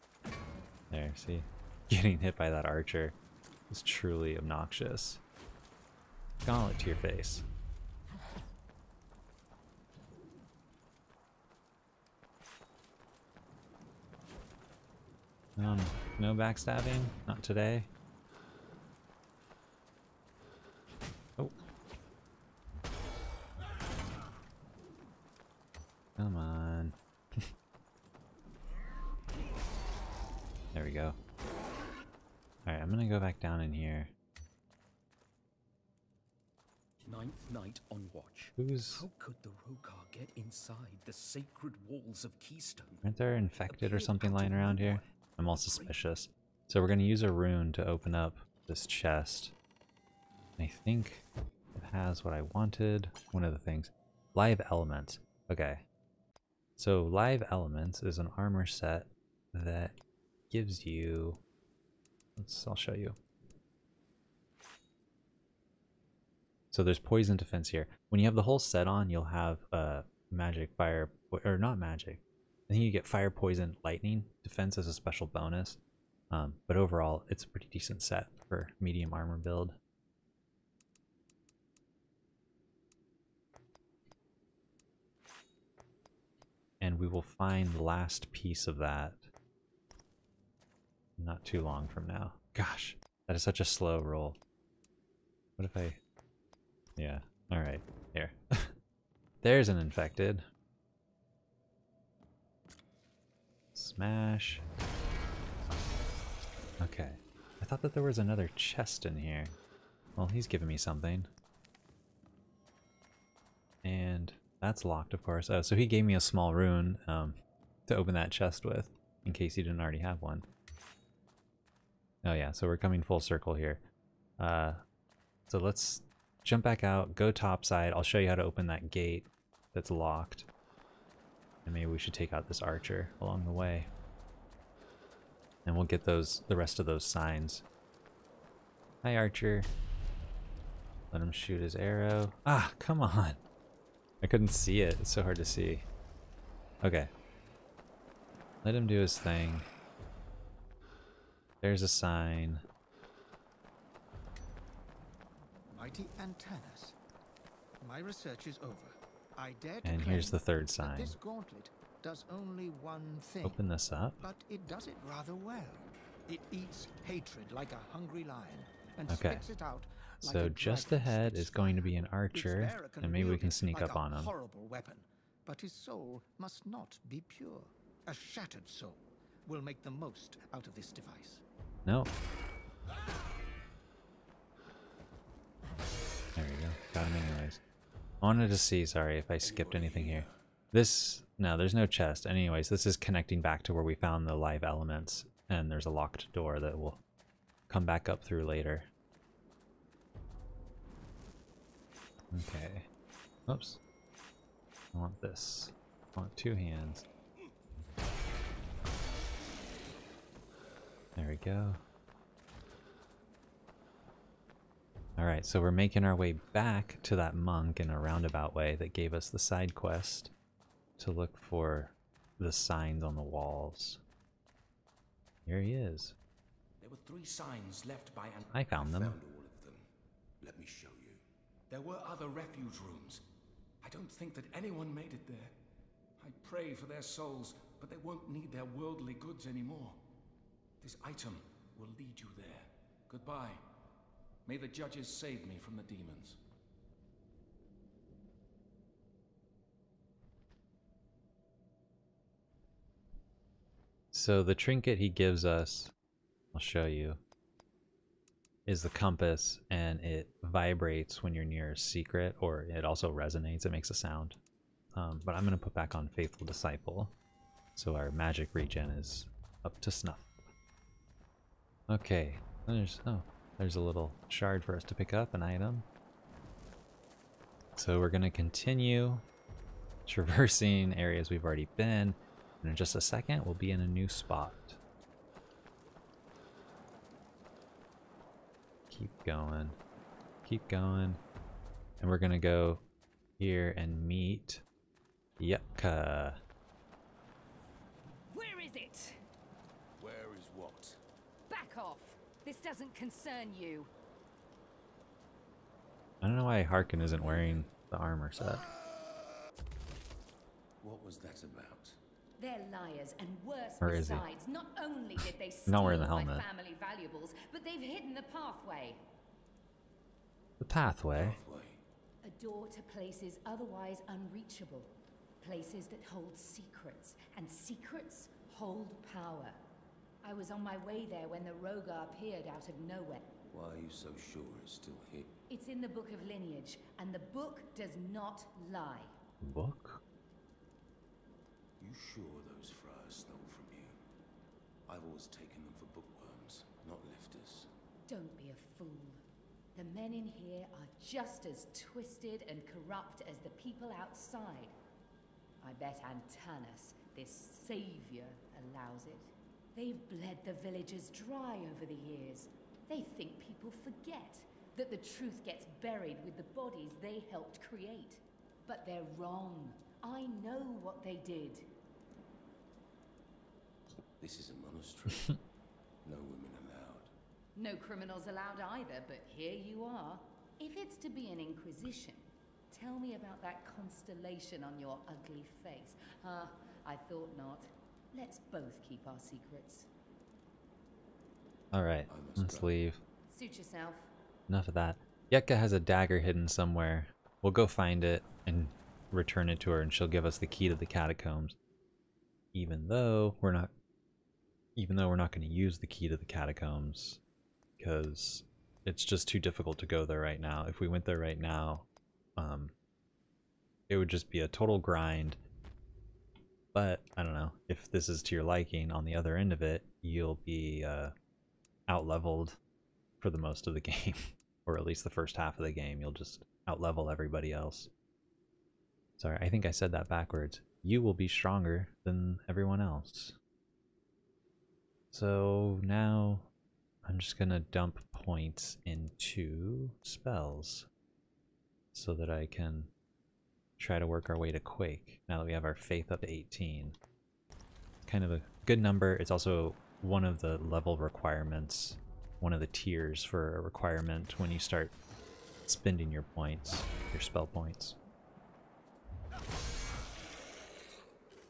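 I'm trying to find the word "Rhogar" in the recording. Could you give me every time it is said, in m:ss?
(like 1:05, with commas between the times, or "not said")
0:39, 5:31.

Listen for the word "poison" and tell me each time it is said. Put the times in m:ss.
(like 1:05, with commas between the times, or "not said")
1:06, 1:13.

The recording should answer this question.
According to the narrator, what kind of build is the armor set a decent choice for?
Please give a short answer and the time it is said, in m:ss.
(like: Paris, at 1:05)
Medium armor build, at 1:18.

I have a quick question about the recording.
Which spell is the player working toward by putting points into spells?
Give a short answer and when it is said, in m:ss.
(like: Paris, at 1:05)
Quake, at 7:24.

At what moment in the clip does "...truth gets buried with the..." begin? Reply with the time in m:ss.
6:04.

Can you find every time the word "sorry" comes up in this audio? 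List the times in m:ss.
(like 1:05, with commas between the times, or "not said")
3:08, 7:09.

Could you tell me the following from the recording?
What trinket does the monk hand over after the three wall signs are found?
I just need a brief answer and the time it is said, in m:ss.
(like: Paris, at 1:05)
Compass, at 4:18.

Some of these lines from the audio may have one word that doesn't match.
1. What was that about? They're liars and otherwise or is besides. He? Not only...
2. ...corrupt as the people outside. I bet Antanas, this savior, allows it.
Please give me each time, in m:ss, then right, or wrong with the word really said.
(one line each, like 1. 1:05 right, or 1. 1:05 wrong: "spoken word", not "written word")
1. 5:10 wrong: "worse", not "otherwise"
2. 5:52 right.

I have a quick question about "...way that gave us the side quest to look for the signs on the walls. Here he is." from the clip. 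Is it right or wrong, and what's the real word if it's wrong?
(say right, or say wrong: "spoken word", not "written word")
right.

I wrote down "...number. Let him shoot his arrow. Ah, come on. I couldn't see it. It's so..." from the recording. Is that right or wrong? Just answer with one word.
wrong.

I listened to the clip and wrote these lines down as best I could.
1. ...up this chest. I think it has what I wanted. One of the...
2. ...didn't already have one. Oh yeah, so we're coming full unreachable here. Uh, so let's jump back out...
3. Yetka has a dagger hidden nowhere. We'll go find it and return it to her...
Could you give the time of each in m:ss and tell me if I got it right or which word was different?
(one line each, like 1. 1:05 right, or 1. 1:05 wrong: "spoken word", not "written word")
1. 0:48 right
2. 1:59 wrong: "circle", not "unreachable"
3. 6:35 wrong: "somewhere", not "nowhere".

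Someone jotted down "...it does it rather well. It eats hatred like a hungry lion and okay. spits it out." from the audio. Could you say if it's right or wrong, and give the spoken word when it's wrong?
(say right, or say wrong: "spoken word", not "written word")
right.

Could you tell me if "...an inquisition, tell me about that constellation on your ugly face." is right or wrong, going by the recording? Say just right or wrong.
right.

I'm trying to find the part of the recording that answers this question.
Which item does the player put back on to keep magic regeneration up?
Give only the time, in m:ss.
4:26.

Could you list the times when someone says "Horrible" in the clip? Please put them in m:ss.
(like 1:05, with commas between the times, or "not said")
2:54.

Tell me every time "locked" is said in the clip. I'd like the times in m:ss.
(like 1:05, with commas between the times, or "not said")
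1:54, 2:09, 3:15.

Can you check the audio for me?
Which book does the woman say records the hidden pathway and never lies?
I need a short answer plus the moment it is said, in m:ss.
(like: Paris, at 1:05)
Book of Lineage, at 5:35.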